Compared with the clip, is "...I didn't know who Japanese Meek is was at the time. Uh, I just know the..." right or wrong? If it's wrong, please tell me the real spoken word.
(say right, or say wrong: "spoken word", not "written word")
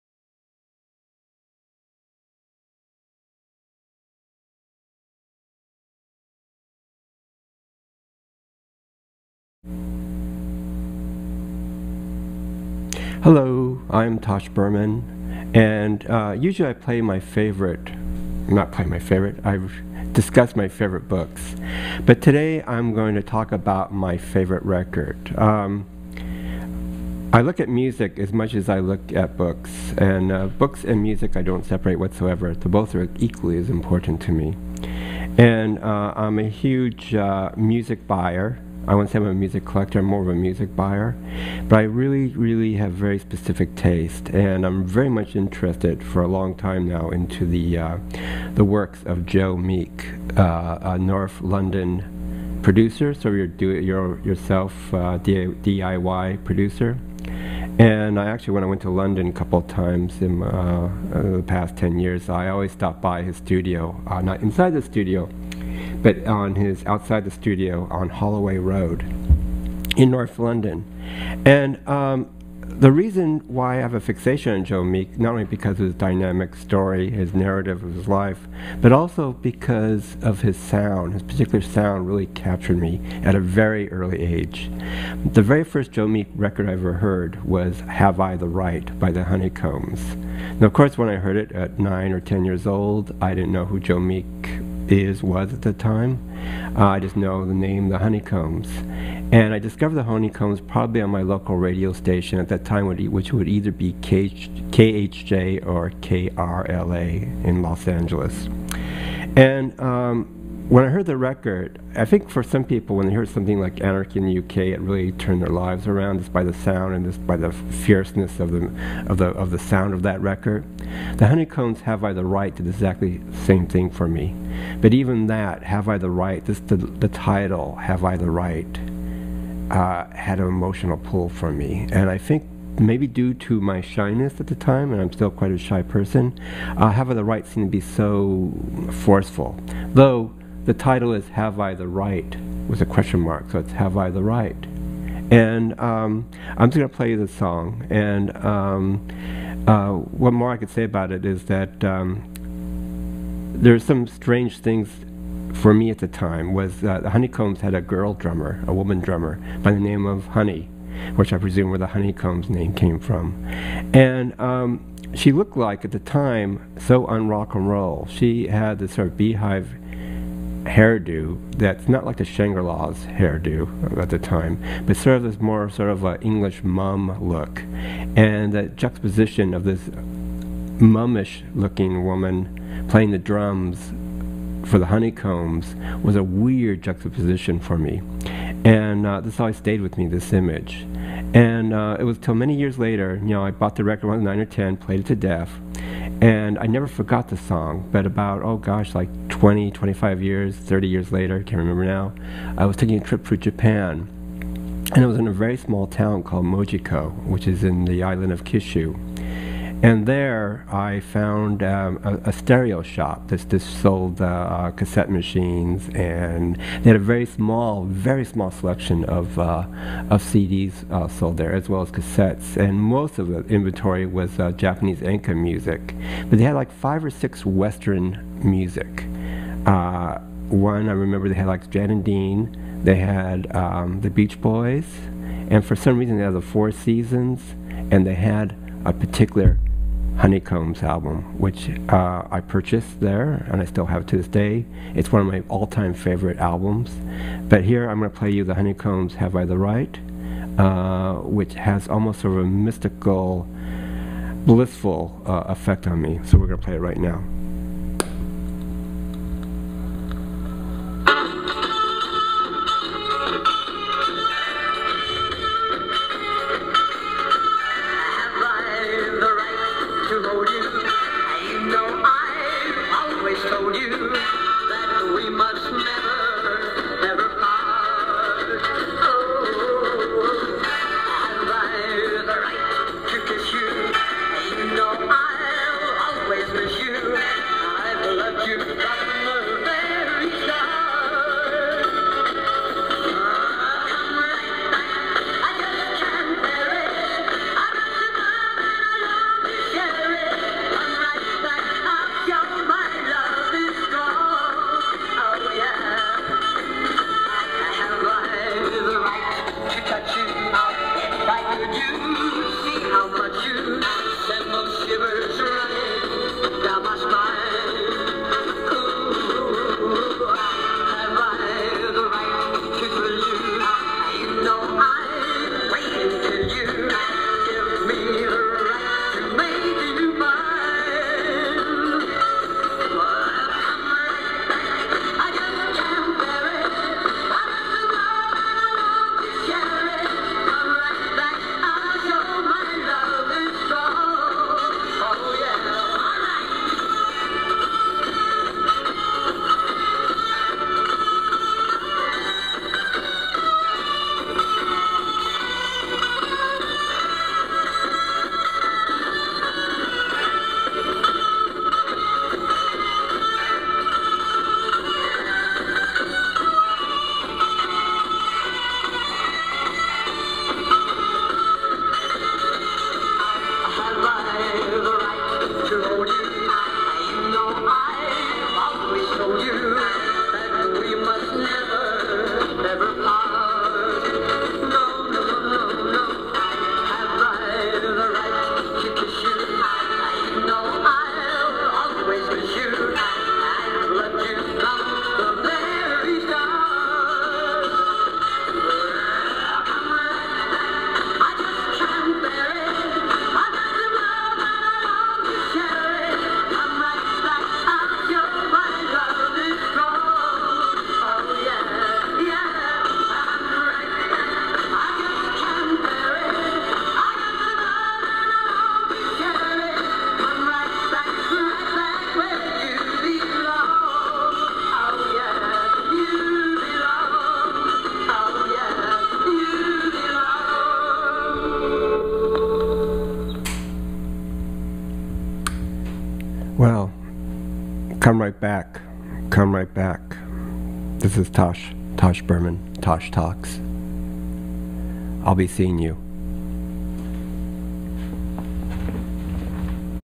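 wrong: "Joe", not "Japanese".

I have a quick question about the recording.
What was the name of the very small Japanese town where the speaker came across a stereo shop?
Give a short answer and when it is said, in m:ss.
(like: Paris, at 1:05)
Mojiko, at 3:26.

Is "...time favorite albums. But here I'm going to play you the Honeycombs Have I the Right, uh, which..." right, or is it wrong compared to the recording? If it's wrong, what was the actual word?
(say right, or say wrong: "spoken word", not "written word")
right.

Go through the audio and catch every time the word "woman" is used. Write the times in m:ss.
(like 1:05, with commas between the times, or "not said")
2:38, 3:02.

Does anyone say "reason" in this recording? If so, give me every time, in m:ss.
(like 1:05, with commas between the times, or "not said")
1:12, 3:55.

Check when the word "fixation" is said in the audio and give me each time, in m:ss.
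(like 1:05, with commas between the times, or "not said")
1:13.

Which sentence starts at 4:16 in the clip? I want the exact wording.
So we're going to play it right now.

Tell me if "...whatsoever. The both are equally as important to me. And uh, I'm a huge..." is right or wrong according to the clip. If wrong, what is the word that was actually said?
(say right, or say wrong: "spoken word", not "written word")
right.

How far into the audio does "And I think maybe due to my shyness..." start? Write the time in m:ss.
2:11.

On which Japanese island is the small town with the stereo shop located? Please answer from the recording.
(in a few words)
Kyushu.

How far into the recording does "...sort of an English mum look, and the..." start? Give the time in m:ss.
2:55.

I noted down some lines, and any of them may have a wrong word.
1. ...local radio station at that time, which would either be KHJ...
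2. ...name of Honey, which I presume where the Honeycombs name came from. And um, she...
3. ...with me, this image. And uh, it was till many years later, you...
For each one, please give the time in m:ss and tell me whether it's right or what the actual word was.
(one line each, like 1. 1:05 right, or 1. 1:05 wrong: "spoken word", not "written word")
1. 1:41 right
2. 2:39 right
3. 3:09 right.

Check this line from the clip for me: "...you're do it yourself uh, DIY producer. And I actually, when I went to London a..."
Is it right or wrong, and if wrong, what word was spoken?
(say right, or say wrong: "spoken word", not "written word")
right.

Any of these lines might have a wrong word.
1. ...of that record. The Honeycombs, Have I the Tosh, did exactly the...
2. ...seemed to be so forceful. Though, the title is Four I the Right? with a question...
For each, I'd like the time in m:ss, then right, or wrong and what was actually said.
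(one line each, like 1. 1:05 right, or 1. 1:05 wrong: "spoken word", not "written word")
1. 1:59 wrong: "Right", not "Tosh"
2. 2:17 wrong: "Have", not "Four".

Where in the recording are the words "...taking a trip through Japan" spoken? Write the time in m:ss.
3:22.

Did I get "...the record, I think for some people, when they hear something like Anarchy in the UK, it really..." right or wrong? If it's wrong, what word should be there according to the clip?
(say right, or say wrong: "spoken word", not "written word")
right.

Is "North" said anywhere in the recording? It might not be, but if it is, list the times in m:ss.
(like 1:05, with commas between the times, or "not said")
0:50, 1:10.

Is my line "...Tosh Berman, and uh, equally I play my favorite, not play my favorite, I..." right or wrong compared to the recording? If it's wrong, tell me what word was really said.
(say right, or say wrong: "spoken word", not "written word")
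wrong: "usually", not "equally".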